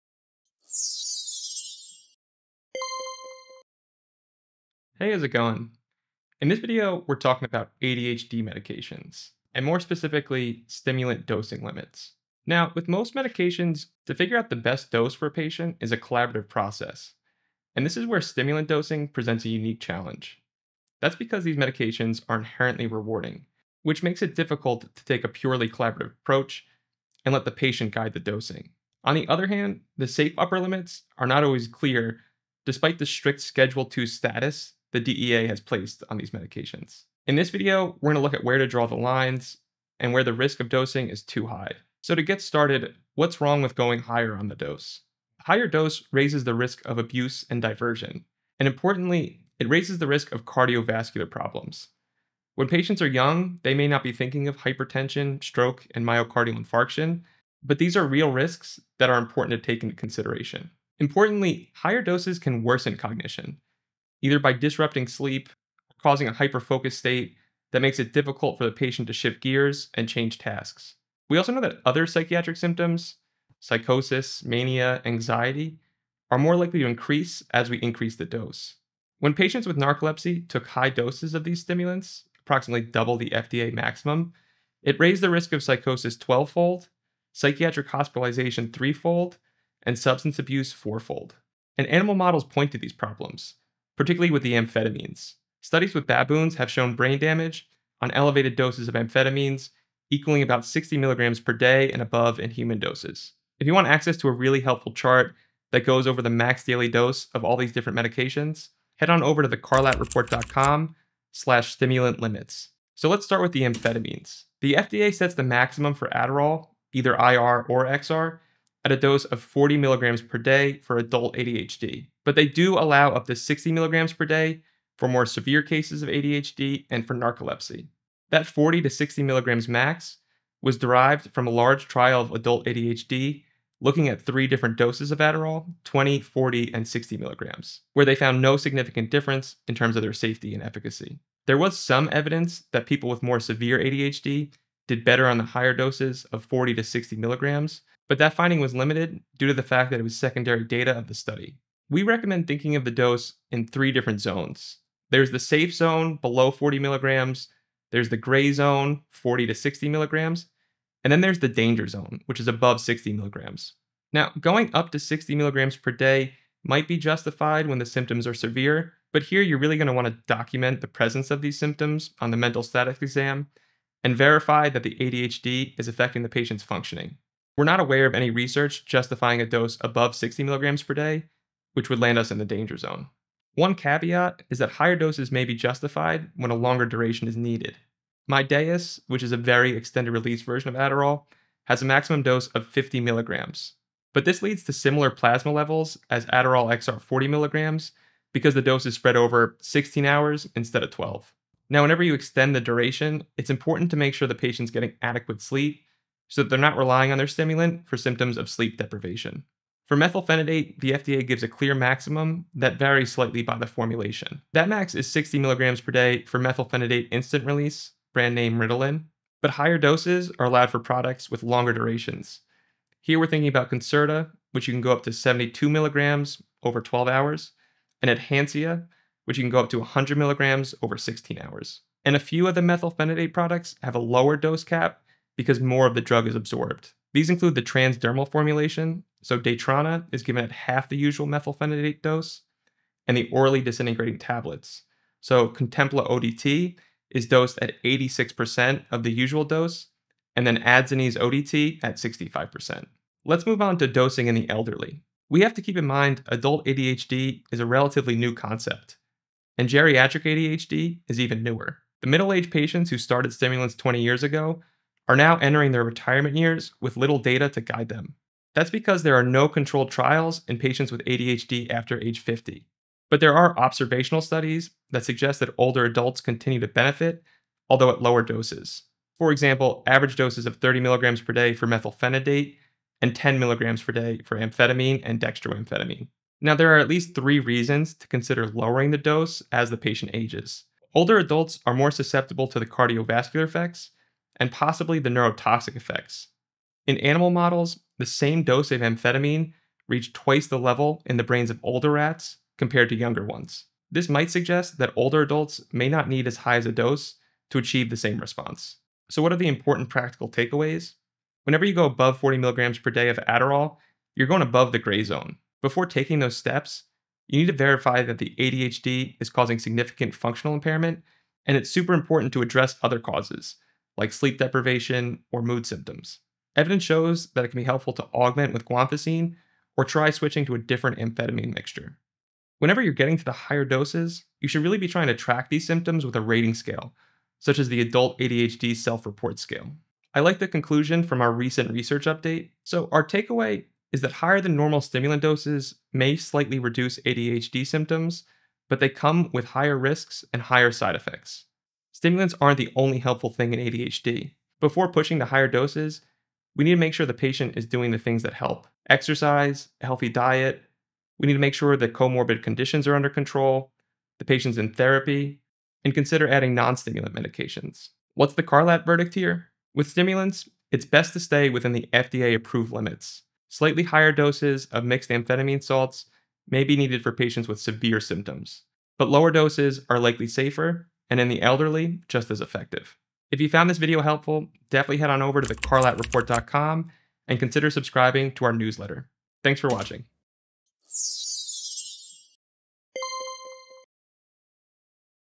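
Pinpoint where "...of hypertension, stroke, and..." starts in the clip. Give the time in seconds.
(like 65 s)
54 s.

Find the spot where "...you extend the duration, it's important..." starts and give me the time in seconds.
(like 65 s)
202 s.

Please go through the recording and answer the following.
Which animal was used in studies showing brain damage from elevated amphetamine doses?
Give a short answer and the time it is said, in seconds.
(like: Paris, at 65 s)
baboons, at 96 s.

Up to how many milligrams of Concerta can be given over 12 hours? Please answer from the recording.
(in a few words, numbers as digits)
72 milligrams.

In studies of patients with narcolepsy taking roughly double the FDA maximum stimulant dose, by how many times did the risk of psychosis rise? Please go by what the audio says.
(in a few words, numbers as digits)
12 fold.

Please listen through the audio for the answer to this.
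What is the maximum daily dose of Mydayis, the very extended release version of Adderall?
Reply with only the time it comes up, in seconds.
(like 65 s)
192 s.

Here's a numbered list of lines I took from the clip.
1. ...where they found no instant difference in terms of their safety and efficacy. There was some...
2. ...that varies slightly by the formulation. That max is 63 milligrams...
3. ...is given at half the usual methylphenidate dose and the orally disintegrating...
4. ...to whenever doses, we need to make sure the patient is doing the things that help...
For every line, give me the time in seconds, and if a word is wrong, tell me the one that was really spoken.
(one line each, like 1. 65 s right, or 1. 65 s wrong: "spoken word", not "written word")
1. 137 s wrong: "significant", not "instant"
2. 212 s wrong: "60", not "63"
3. 240 s right
4. 355 s wrong: "higher", not "whenever".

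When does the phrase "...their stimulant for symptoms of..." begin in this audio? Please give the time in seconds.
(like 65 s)
207 s.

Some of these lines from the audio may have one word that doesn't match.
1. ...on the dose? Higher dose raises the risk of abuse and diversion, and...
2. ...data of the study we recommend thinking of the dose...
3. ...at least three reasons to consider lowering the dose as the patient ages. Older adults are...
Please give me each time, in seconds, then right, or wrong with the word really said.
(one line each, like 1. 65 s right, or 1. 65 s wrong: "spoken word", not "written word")
1. 44 s right
2. 150 s right
3. 286 s right.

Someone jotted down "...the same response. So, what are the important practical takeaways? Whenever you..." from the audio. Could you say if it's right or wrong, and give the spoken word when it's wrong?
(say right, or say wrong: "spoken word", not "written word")
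right.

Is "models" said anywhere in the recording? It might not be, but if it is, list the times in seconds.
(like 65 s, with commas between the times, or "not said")
92 s, 297 s.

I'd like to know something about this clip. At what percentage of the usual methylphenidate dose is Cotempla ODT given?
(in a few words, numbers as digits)
86%.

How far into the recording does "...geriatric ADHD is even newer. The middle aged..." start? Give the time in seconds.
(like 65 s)
259 s.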